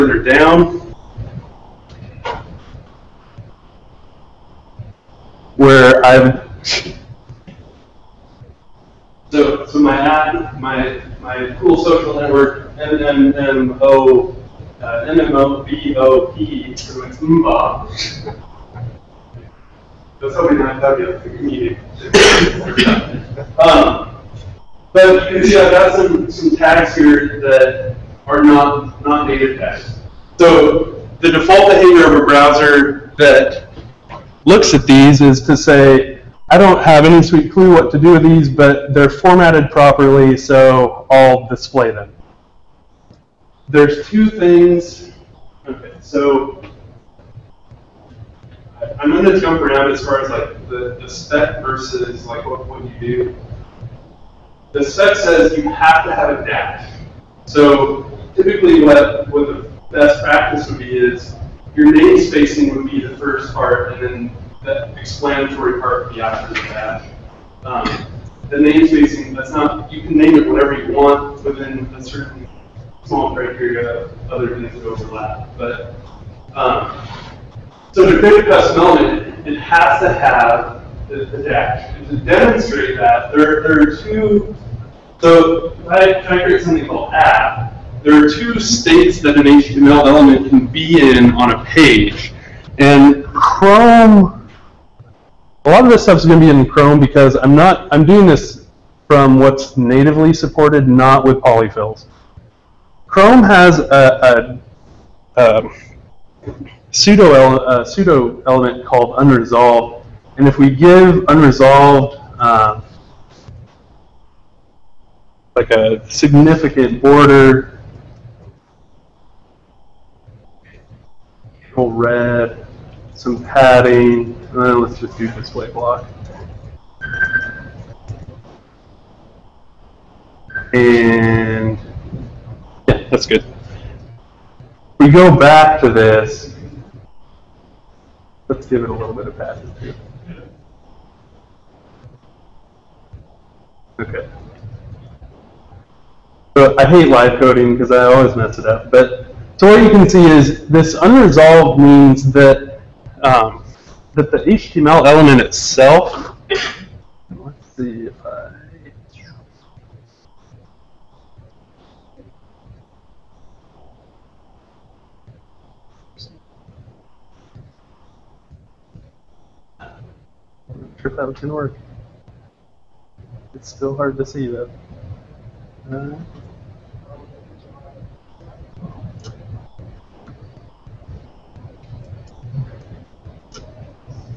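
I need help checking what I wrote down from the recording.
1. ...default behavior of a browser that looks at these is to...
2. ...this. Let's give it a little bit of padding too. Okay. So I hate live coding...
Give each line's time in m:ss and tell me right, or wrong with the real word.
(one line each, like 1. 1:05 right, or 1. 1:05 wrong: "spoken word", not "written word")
1. 0:31 right
2. 2:15 right.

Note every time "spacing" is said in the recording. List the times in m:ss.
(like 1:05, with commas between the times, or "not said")
1:02, 1:08.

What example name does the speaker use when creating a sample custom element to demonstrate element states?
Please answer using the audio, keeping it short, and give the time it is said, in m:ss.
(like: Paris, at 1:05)
app, at 1:27.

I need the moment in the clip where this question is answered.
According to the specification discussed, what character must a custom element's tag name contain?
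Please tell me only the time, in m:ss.
0:56.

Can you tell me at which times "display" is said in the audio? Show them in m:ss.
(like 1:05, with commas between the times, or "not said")
0:41, 2:05.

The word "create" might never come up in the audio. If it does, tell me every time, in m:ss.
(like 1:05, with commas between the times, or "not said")
1:18, 1:26.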